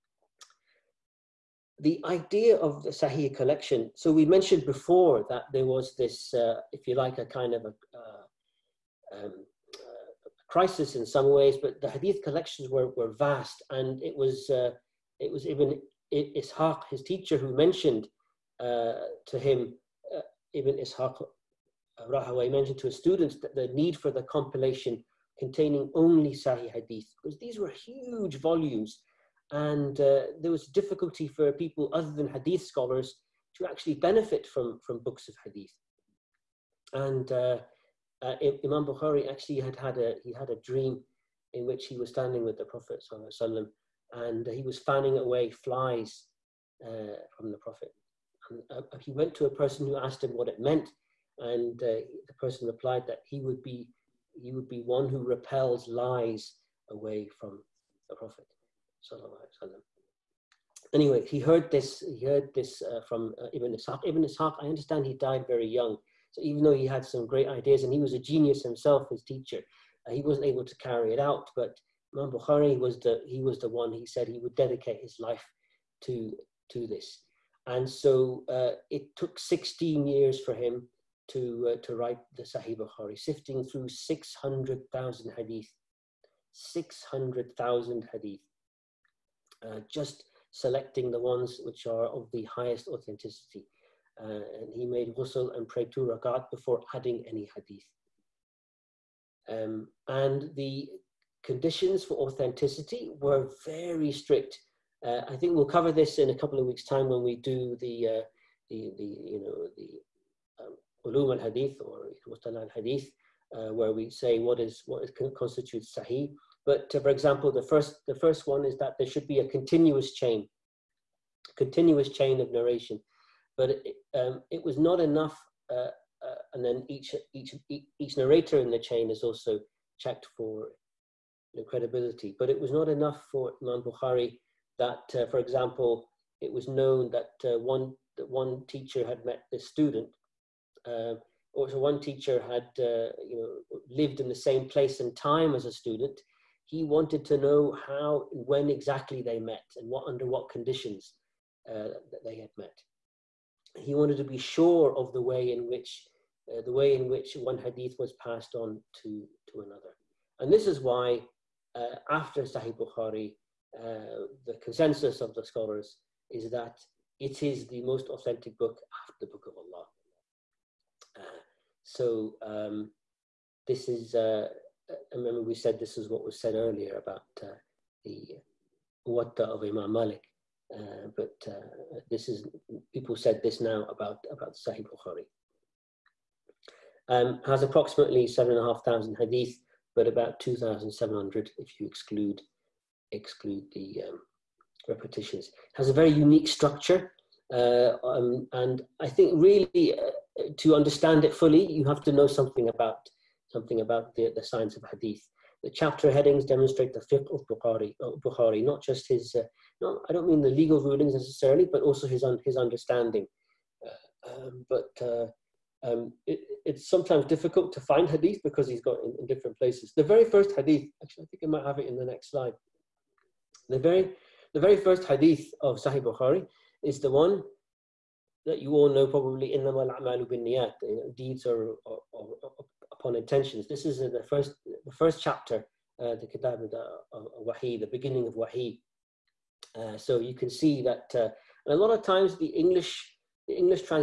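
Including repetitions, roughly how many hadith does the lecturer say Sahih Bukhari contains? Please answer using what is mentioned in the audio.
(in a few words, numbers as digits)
7,500.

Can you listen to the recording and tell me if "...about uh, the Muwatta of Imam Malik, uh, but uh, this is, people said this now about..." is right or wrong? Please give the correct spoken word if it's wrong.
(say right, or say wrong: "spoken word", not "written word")
right.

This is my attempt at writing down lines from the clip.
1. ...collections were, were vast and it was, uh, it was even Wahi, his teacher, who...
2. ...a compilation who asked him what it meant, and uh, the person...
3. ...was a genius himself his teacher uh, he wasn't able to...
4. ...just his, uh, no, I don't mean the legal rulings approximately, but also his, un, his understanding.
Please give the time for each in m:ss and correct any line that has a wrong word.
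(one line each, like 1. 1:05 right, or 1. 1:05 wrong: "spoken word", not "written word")
1. 0:12 wrong: "Ishaq", not "Wahi"
2. 0:49 wrong: "person", not "compilation"
3. 1:07 right
4. 3:28 wrong: "necessarily", not "approximately".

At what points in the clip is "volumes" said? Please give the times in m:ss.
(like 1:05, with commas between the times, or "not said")
0:28.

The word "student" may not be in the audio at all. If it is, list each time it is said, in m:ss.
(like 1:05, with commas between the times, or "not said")
0:22, 2:19, 2:25.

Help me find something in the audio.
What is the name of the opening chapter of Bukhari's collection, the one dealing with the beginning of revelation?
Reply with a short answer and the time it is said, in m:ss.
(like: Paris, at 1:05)
Kitab al-Wahi, at 3:56.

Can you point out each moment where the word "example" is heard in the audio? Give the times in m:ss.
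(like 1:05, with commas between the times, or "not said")
1:57, 2:15.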